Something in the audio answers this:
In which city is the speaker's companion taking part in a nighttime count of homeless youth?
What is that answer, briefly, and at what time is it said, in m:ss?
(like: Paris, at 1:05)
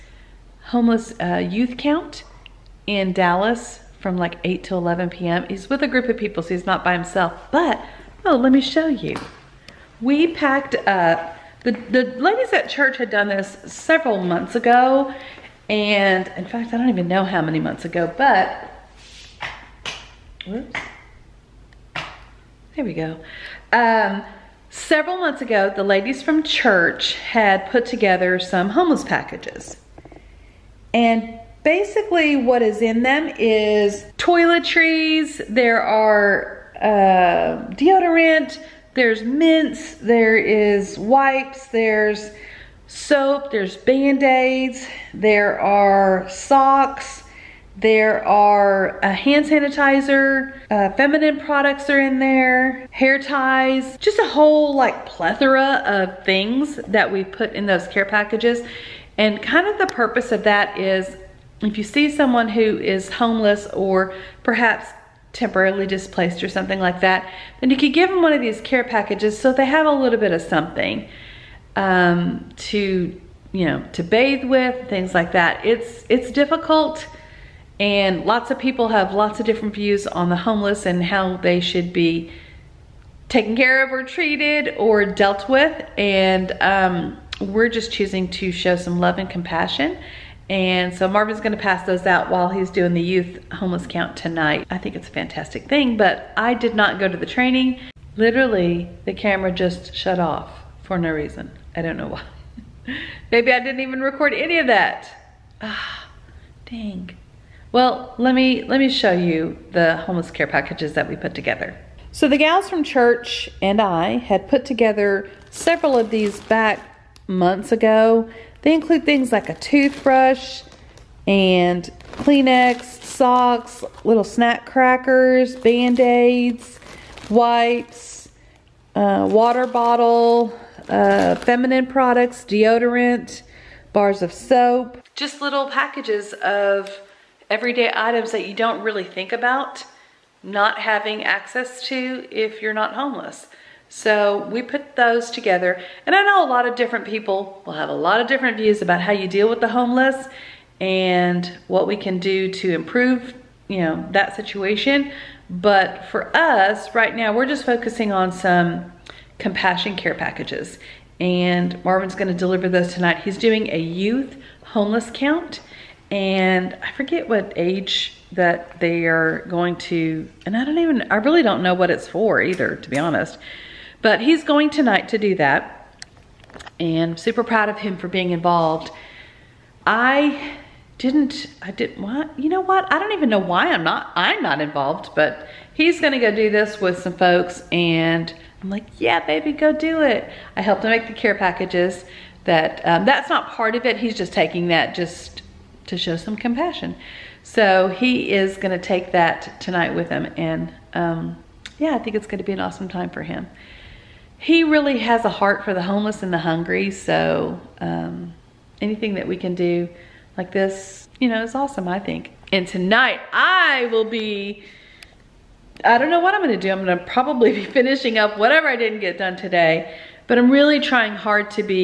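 Dallas, at 0:03.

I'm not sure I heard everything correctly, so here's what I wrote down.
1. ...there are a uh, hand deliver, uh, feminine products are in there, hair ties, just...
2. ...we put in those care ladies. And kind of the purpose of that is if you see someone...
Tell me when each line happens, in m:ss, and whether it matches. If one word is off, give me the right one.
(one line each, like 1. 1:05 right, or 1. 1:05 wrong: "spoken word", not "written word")
1. 0:47 wrong: "sanitizer", not "deliver"
2. 0:57 wrong: "packages", not "ladies".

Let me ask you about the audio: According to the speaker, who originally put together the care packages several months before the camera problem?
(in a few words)
The ladies at church.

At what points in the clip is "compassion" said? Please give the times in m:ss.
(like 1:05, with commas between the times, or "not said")
1:29, 2:39, 3:16.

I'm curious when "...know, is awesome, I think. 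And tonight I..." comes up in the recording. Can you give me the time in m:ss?
3:31.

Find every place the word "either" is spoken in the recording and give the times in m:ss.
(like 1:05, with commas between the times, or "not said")
2:52.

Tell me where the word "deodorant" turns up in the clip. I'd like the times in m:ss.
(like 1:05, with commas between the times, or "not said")
0:37, 2:12.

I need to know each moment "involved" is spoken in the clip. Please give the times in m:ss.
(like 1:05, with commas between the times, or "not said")
2:58, 3:04.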